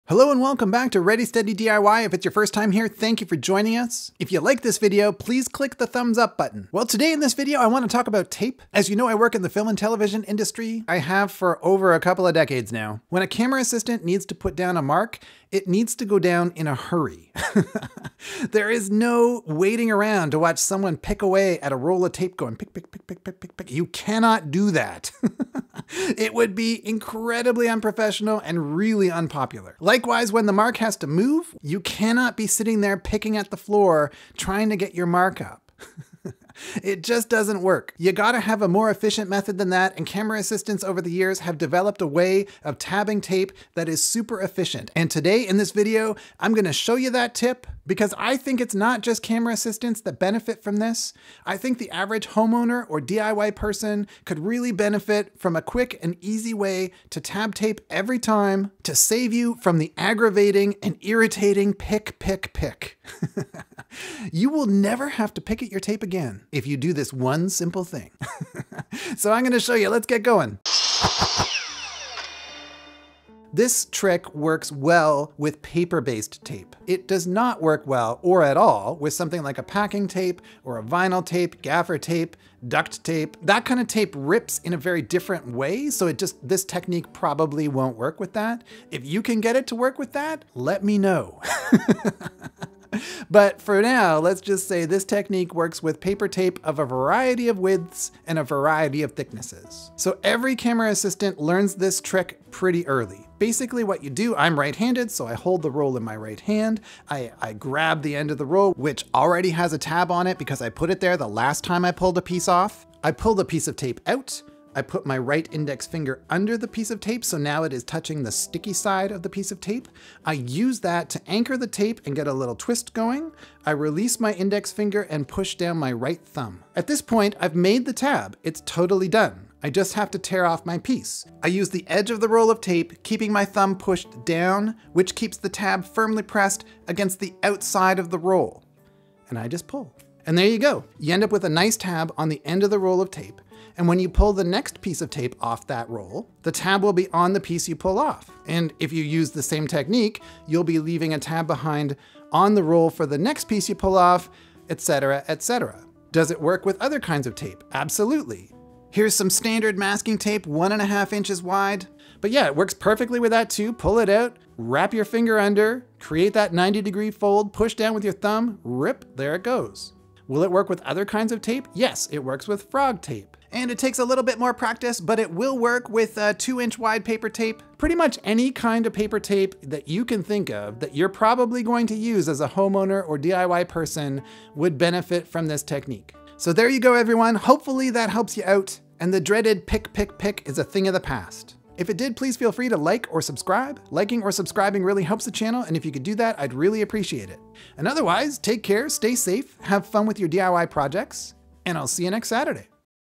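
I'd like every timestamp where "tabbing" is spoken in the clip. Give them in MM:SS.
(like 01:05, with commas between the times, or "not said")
00:42.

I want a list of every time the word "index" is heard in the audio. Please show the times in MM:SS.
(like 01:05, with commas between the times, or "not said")
01:55, 02:04.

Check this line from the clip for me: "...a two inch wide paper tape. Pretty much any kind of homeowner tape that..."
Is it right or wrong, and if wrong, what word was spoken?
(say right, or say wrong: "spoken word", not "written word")
wrong: "paper", not "homeowner".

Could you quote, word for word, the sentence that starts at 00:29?
Likewise, when the mark has to move, you cannot be sitting there picking at the floor trying to get your mark up.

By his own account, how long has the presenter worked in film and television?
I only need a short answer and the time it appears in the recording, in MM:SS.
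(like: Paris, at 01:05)
over a couple of decades, at 00:11.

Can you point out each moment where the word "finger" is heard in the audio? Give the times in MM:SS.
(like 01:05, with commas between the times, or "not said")
01:55, 02:04, 02:45.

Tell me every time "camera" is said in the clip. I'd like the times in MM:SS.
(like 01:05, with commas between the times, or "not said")
00:13, 00:40, 00:49, 01:40.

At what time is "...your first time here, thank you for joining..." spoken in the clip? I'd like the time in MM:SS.
00:02.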